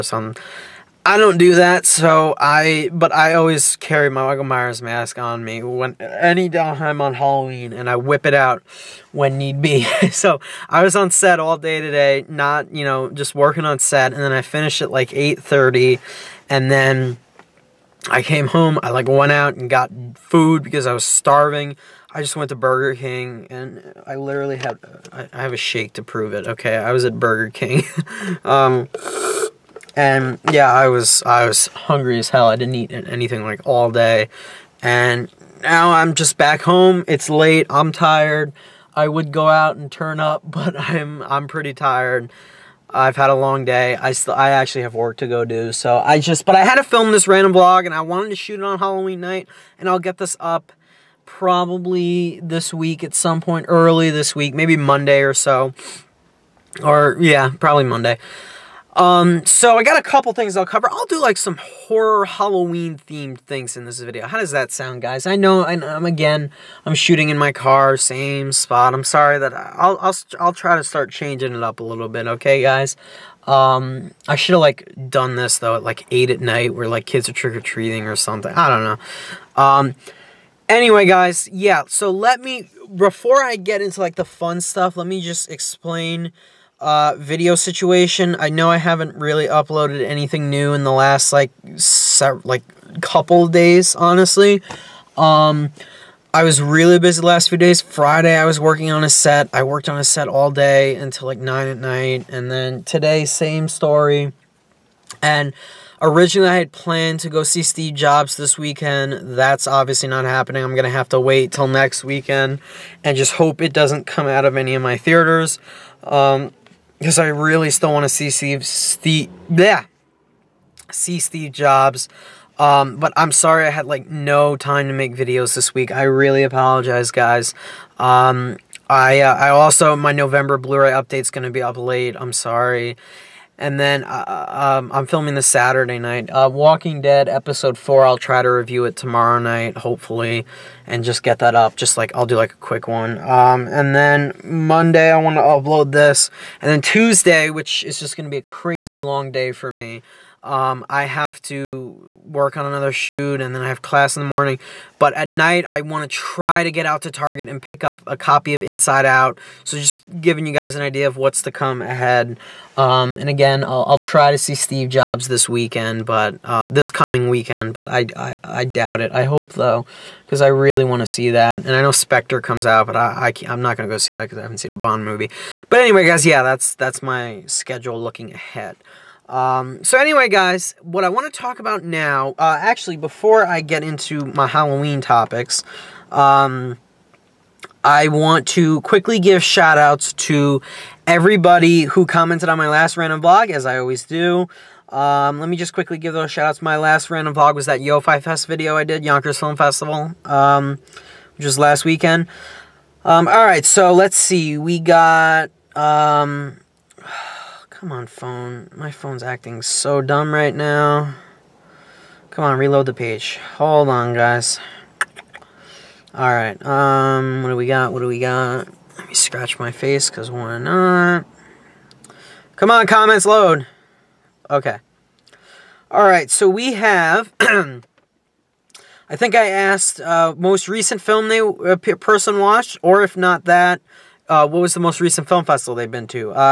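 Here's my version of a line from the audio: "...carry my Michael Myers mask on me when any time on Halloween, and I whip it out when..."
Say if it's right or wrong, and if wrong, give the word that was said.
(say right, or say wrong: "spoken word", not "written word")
right.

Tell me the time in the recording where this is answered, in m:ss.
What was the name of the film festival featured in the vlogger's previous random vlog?
3:19.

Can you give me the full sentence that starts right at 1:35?
Um, I was really busy the last few days.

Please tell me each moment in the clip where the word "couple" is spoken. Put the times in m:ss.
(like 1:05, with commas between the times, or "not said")
1:00, 1:33.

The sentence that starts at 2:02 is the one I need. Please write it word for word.
Um, but I'm sorry I had like no time to make videos this week.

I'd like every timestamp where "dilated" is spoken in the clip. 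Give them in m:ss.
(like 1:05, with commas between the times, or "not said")
not said.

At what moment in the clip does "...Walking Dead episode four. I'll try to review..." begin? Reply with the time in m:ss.
2:16.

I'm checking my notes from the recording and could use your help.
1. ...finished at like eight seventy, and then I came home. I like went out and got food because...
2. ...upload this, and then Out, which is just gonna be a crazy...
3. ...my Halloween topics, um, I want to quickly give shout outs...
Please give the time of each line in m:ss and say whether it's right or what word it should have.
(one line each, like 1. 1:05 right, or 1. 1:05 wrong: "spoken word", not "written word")
1. 0:14 wrong: "thirty", not "seventy"
2. 2:25 wrong: "Tuesday", not "Out"
3. 3:04 right.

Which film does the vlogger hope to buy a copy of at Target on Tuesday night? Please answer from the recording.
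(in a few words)
Inside Out.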